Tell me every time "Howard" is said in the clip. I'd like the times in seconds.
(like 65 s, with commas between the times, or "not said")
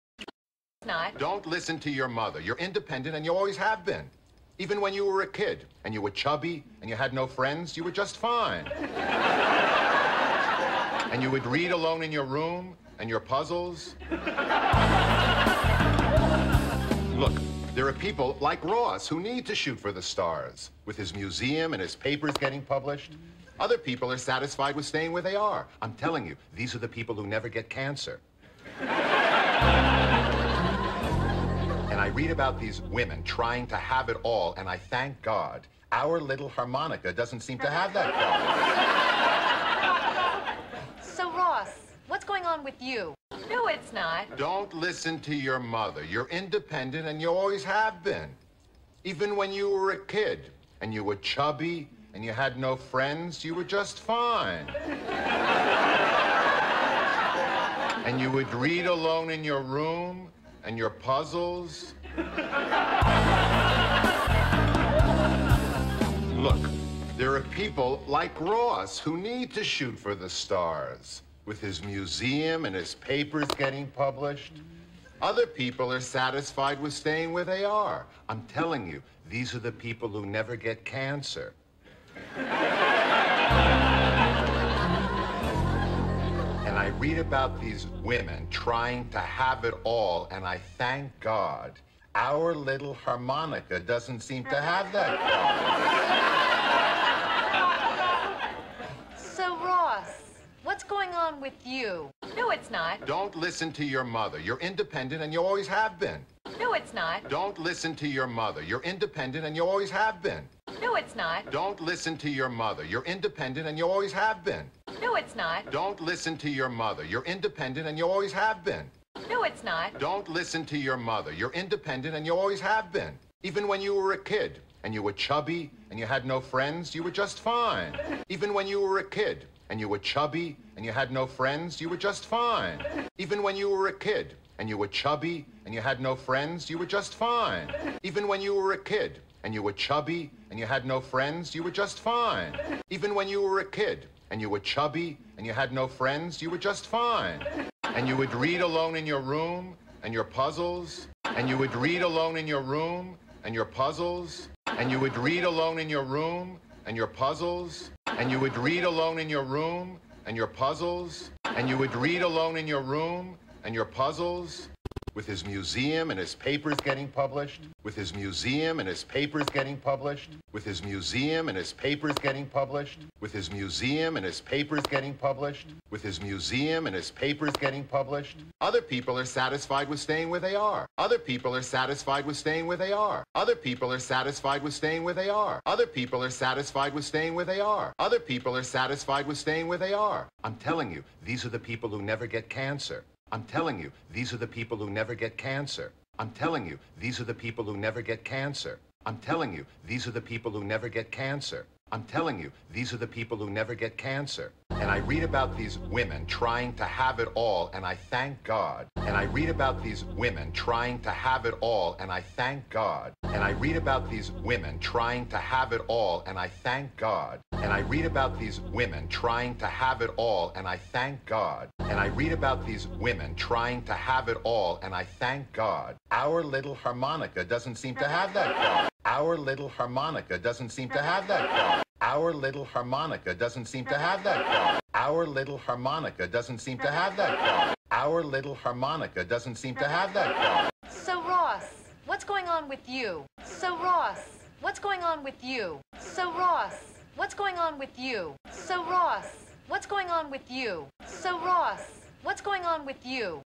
not said.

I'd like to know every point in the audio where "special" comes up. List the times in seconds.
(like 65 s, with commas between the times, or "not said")
not said.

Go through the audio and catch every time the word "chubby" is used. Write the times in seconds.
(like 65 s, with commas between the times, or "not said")
6 s, 51 s, 125 s, 129 s, 135 s, 139 s, 144 s.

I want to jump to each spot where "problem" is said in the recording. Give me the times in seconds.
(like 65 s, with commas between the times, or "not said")
40 s.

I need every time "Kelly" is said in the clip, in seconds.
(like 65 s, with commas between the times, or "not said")
not said.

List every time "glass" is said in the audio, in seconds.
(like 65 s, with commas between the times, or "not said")
not said.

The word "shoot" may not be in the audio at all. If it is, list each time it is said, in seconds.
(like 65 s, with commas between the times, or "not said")
19 s, 69 s.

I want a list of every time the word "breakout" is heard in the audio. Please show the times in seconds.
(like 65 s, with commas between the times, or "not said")
not said.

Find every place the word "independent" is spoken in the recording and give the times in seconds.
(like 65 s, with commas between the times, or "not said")
2 s, 46 s, 104 s, 108 s, 113 s, 117 s, 121 s.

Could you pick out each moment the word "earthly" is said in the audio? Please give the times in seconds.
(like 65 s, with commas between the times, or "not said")
not said.